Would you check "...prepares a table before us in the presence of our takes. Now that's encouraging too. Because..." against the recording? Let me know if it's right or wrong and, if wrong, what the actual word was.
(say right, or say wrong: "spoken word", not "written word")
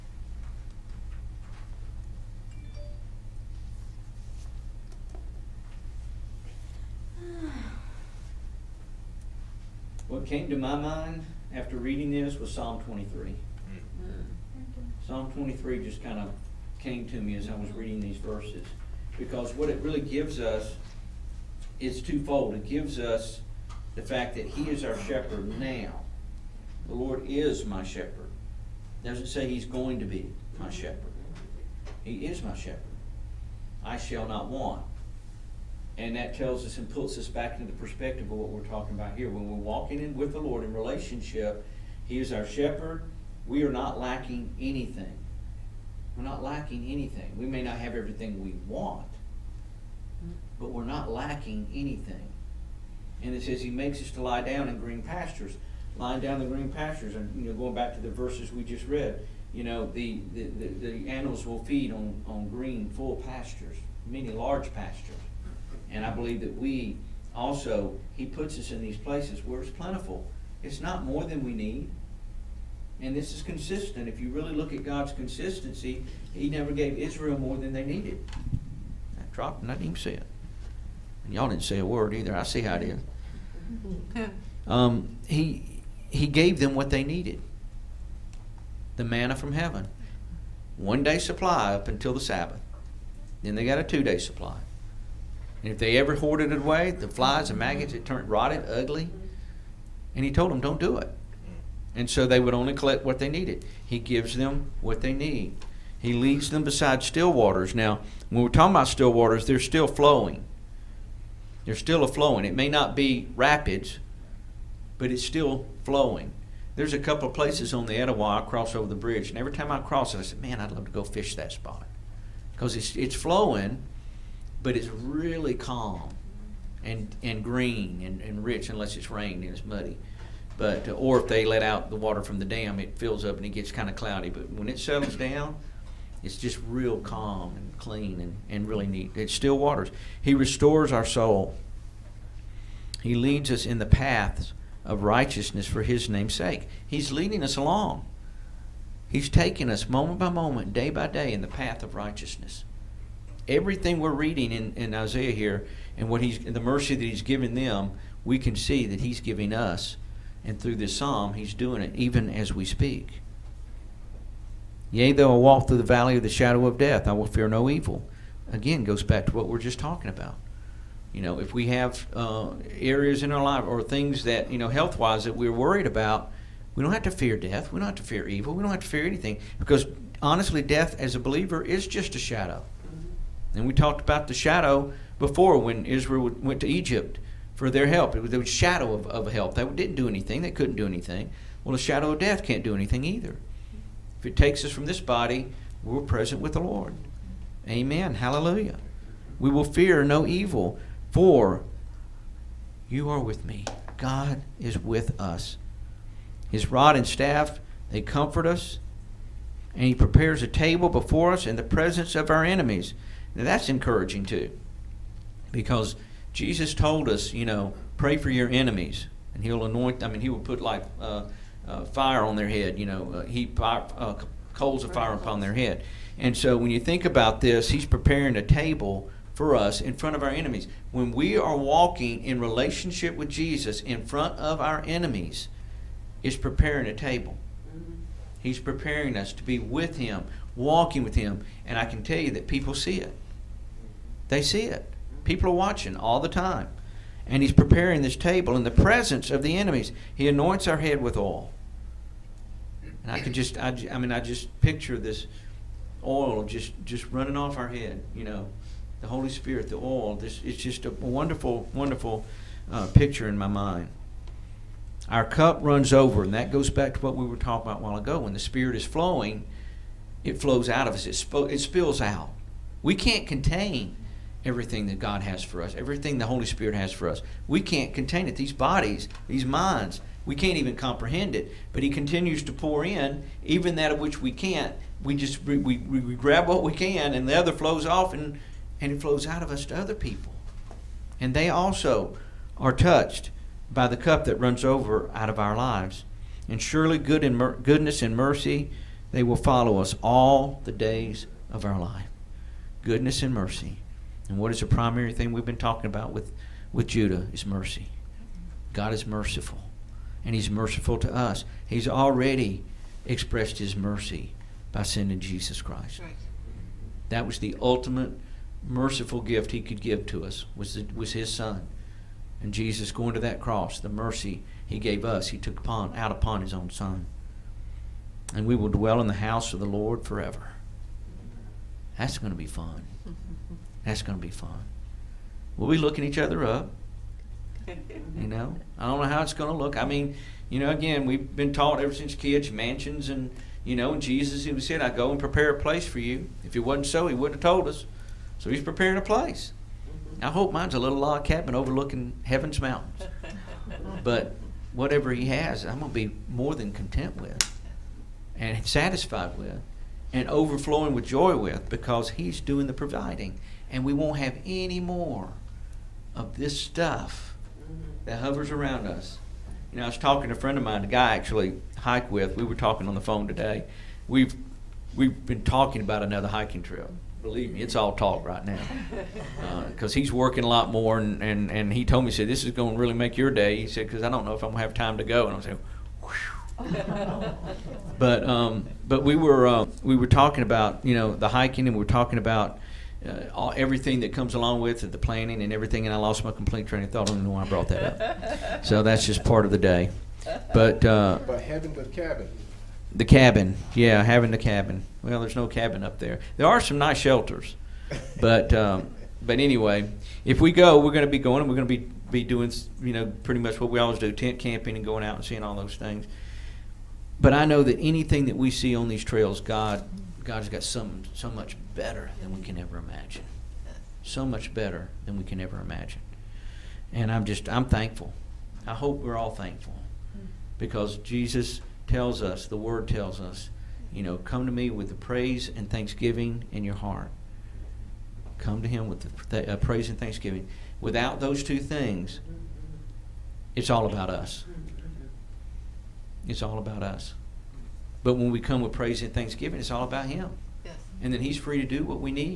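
wrong: "enemies", not "takes".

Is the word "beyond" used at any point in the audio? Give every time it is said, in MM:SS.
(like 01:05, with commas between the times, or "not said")
not said.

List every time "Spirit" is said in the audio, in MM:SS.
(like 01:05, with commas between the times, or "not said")
04:19, 04:28, 04:36.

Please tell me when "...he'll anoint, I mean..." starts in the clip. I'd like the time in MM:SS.
03:39.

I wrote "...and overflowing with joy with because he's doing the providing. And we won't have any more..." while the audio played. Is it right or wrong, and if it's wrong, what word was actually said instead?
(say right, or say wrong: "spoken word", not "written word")
right.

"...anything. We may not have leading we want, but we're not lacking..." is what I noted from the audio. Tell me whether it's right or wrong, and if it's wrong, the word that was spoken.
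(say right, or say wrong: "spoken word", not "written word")
wrong: "everything", not "leading".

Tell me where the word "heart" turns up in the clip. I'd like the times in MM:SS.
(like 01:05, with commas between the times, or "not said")
07:16.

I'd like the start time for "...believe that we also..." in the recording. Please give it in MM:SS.
01:06.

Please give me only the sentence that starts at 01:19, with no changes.
I dropped and I didn't even see it.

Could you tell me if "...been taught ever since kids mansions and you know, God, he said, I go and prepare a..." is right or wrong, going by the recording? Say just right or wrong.
wrong.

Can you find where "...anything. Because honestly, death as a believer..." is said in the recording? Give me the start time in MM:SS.
02:59.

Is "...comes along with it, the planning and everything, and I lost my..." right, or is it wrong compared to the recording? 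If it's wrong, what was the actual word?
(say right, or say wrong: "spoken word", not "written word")
right.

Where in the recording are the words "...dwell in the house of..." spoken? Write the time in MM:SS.
05:28.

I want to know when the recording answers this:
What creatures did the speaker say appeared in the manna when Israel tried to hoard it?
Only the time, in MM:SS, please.
01:36.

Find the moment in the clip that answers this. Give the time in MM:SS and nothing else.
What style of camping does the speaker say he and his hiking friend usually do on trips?
06:54.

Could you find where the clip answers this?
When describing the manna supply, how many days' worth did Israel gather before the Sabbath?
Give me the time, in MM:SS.
01:33.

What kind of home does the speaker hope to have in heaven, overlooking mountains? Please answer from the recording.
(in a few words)
log cabin.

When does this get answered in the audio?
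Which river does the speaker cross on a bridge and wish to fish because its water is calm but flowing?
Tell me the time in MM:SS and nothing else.
01:57.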